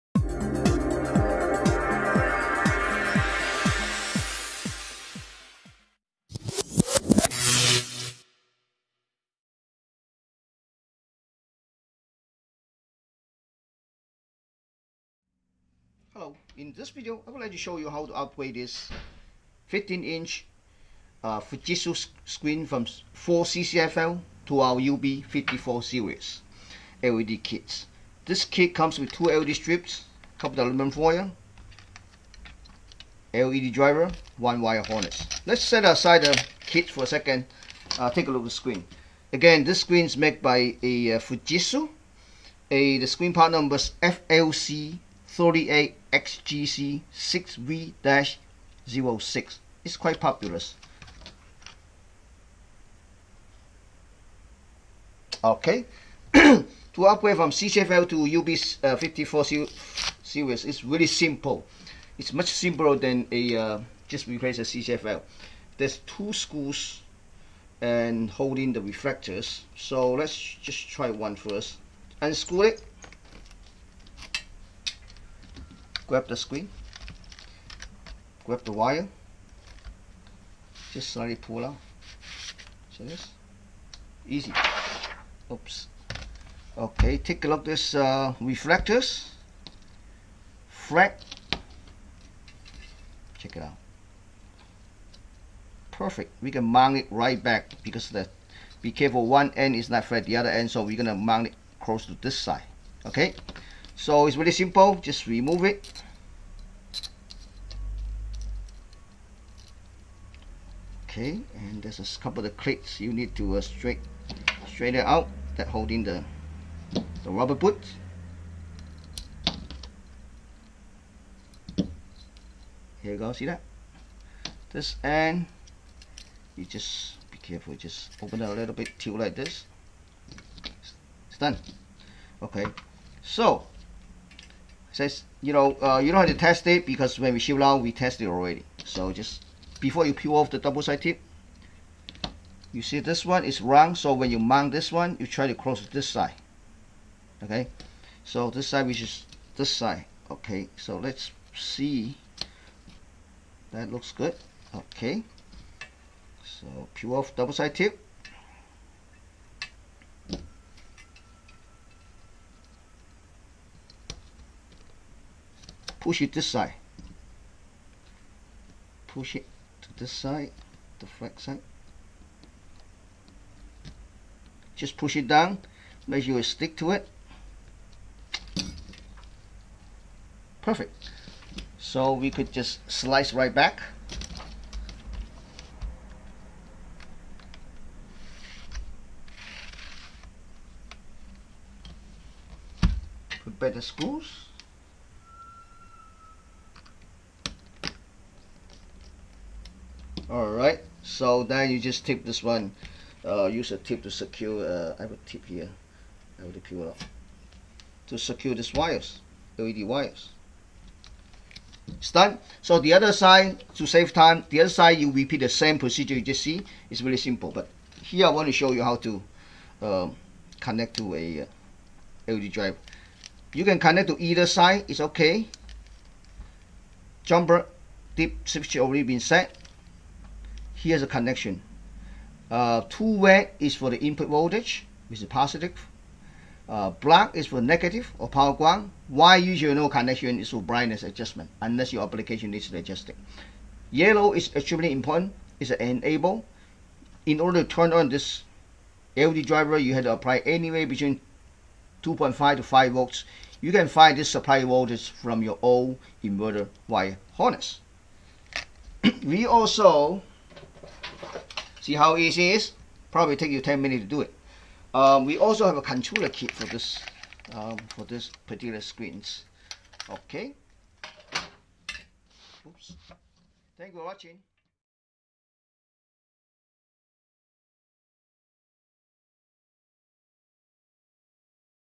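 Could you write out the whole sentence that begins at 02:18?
So just before you peel off the double side tip, you see this one is round.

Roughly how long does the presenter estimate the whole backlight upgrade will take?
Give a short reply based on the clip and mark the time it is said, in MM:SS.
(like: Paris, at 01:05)
10 minutes, at 04:23.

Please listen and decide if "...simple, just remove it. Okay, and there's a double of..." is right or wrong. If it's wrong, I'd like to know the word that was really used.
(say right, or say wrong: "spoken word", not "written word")
wrong: "couple", not "double".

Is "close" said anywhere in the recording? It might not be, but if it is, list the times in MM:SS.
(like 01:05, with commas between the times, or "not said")
01:41, 02:25.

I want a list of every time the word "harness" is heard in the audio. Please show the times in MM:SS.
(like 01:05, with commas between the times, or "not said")
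00:34, 04:17.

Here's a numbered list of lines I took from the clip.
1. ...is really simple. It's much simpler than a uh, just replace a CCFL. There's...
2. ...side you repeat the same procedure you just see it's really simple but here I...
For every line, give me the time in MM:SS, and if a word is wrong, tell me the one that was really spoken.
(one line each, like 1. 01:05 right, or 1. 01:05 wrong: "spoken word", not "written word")
1. 01:00 right
2. 03:34 right.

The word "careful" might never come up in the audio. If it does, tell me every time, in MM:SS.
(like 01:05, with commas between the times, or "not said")
01:38, 02:07.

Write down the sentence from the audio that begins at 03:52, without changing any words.
Uh, two red is for the input voltage, which is positive.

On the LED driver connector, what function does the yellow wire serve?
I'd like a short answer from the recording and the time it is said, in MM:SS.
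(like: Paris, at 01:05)
Enable, at 04:05.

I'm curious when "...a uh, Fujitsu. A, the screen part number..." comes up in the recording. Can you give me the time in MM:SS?
00:40.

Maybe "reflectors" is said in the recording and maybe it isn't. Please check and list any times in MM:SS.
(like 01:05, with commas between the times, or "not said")
01:08, 01:28.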